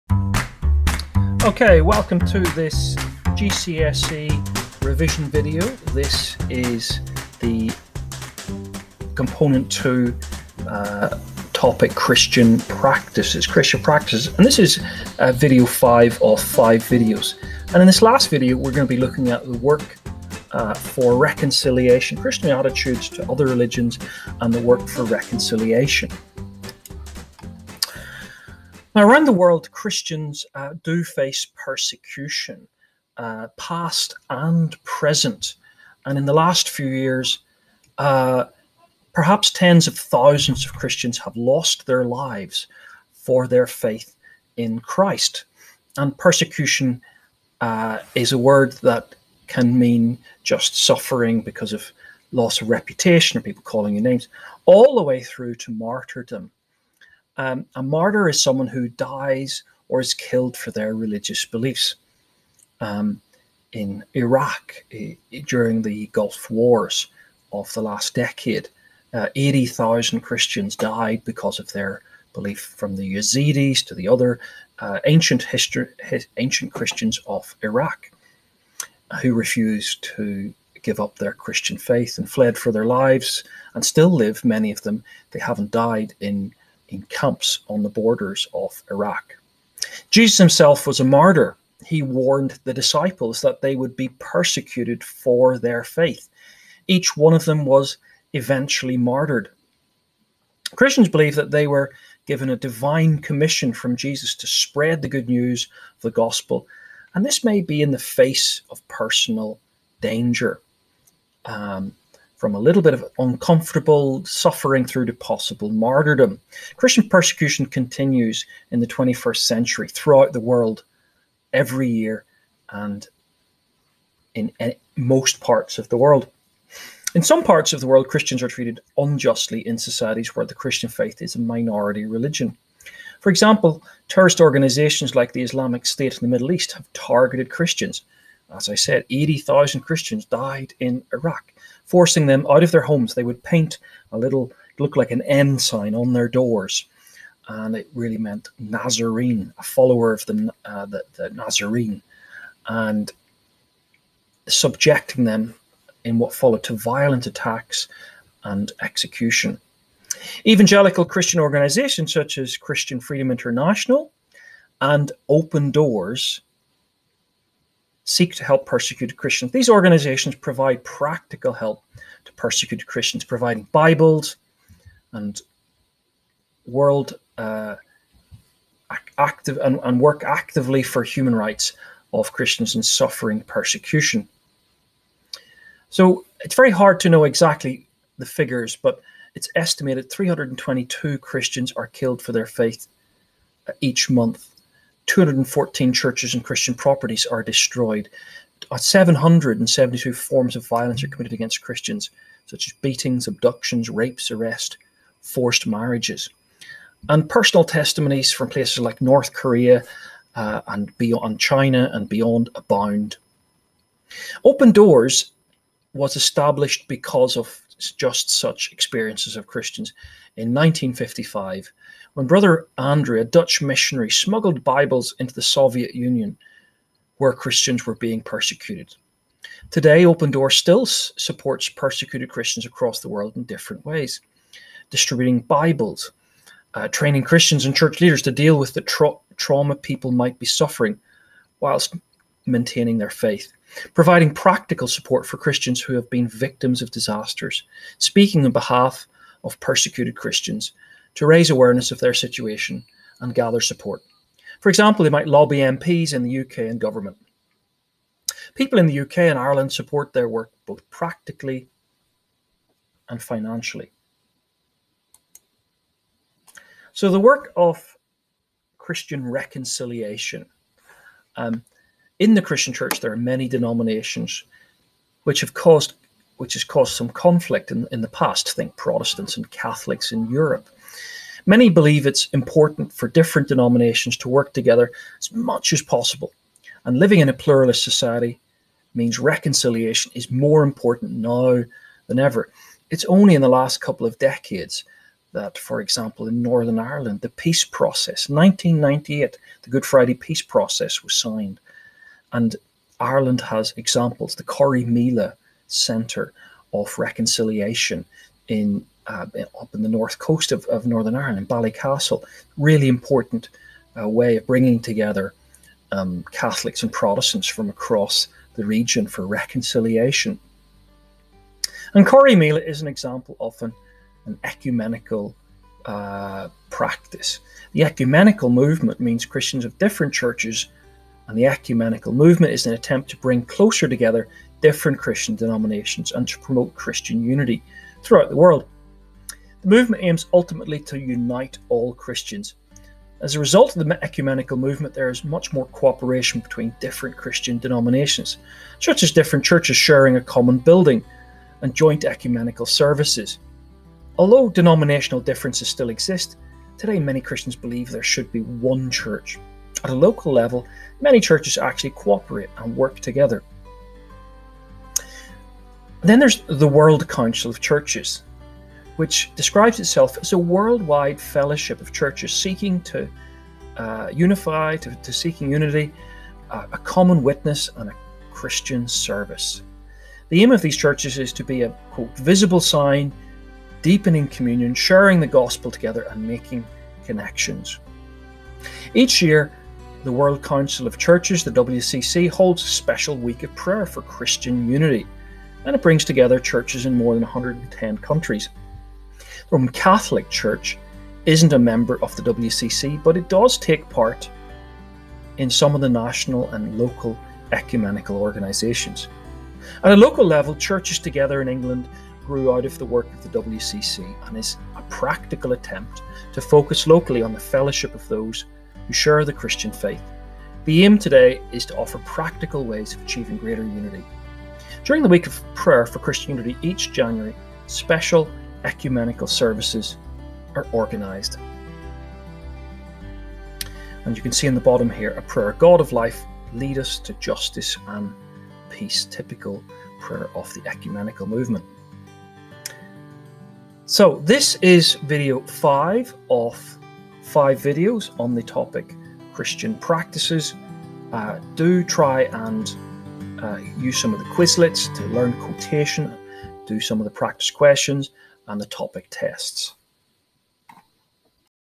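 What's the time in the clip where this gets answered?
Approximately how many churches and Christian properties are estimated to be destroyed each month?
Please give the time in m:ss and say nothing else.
3:15.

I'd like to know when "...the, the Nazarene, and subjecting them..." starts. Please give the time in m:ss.
2:30.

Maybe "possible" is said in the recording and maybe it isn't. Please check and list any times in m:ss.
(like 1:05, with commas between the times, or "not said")
1:55, 4:45.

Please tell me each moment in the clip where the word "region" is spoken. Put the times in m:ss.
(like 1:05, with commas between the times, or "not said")
5:18.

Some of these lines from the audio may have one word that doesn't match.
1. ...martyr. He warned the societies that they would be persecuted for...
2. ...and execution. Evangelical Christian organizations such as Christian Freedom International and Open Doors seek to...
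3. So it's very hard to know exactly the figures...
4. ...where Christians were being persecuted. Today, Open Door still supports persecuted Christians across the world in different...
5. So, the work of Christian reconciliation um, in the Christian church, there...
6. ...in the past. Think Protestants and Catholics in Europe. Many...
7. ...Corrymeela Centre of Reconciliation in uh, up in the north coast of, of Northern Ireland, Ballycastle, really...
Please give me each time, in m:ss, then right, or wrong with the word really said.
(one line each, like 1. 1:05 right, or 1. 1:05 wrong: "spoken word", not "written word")
1. 1:31 wrong: "disciples", not "societies"
2. 2:38 right
3. 3:05 right
4. 3:47 right
5. 4:26 right
6. 4:37 right
7. 5:04 right.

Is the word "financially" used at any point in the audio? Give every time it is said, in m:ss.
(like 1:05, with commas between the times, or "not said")
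4:23.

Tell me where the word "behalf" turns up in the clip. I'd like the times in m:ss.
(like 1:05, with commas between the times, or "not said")
4:08.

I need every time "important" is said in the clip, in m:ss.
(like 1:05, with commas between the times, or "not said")
4:42, 4:50, 5:12.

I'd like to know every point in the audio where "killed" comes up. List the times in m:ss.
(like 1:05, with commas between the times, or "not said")
1:00, 3:11.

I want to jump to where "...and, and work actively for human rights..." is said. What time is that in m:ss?
2:59.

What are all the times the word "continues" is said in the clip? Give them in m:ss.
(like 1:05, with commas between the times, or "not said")
1:57.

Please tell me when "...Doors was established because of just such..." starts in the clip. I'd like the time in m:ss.
3:34.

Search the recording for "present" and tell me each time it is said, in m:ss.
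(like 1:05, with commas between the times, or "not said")
0:34.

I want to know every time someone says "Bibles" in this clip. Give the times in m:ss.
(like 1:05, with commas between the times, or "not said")
2:53, 3:44, 3:55.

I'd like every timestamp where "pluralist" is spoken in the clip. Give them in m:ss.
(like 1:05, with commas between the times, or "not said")
4:47.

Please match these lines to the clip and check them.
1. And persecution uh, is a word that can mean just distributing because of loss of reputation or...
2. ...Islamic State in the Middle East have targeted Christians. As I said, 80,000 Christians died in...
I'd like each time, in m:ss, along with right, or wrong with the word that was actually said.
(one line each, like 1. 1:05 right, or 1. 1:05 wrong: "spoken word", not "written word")
1. 0:45 wrong: "suffering", not "distributing"
2. 2:15 right.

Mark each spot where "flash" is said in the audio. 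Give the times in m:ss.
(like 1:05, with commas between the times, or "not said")
not said.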